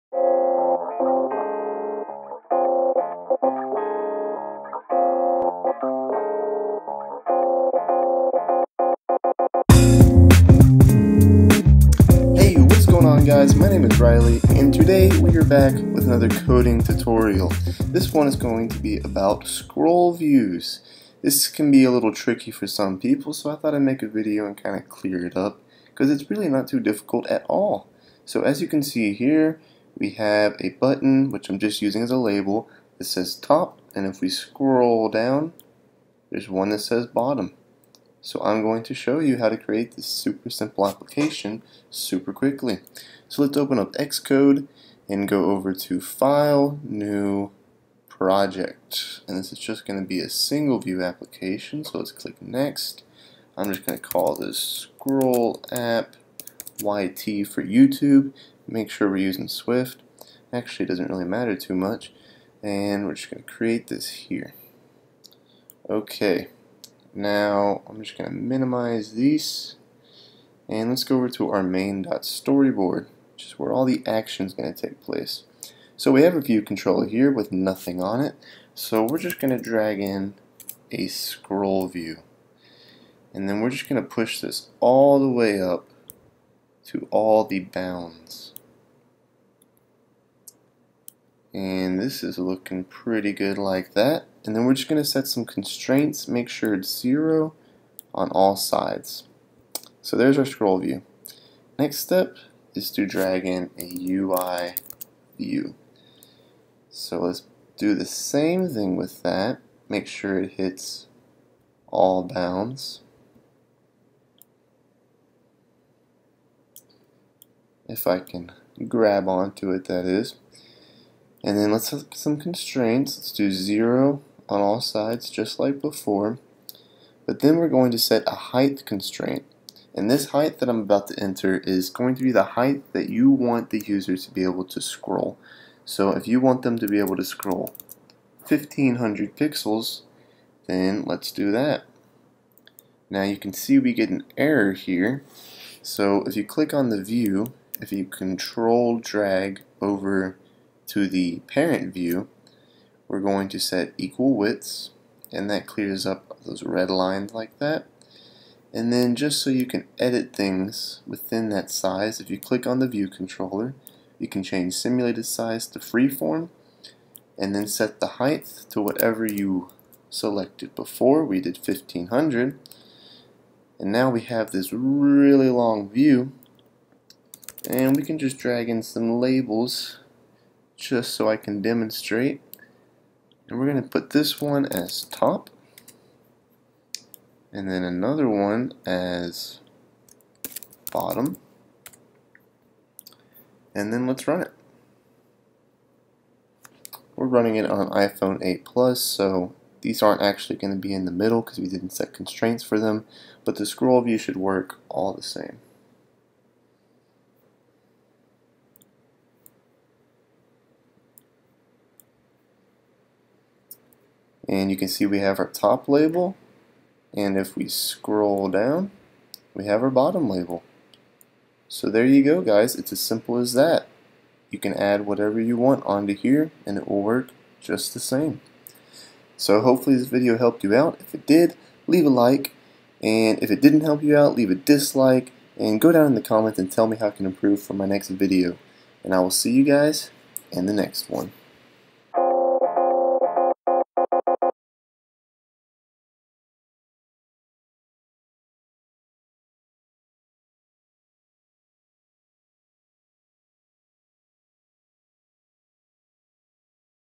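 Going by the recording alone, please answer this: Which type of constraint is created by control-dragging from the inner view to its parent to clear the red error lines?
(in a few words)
equal widths.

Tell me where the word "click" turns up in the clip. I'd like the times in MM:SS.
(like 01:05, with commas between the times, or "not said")
00:52, 02:26, 02:42.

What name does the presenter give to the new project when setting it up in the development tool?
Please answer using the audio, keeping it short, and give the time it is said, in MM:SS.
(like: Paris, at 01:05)
Scroll App YT, at 00:54.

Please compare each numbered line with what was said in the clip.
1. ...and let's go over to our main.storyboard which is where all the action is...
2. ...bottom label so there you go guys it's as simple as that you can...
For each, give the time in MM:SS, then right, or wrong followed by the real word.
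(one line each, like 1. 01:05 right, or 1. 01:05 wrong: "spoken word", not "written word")
1. 01:10 right
2. 03:39 right.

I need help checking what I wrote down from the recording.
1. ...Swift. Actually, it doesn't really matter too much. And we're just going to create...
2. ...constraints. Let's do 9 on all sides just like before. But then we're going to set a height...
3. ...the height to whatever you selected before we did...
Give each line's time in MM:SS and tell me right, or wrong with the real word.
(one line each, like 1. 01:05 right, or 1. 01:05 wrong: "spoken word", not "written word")
1. 00:59 right
2. 02:02 wrong: "0", not "9"
3. 02:47 right.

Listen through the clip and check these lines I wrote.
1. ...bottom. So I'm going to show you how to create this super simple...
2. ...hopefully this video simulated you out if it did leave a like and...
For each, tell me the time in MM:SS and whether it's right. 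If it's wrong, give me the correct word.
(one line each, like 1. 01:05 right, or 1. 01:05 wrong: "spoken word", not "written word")
1. 00:37 right
2. 03:49 wrong: "helped", not "simulated".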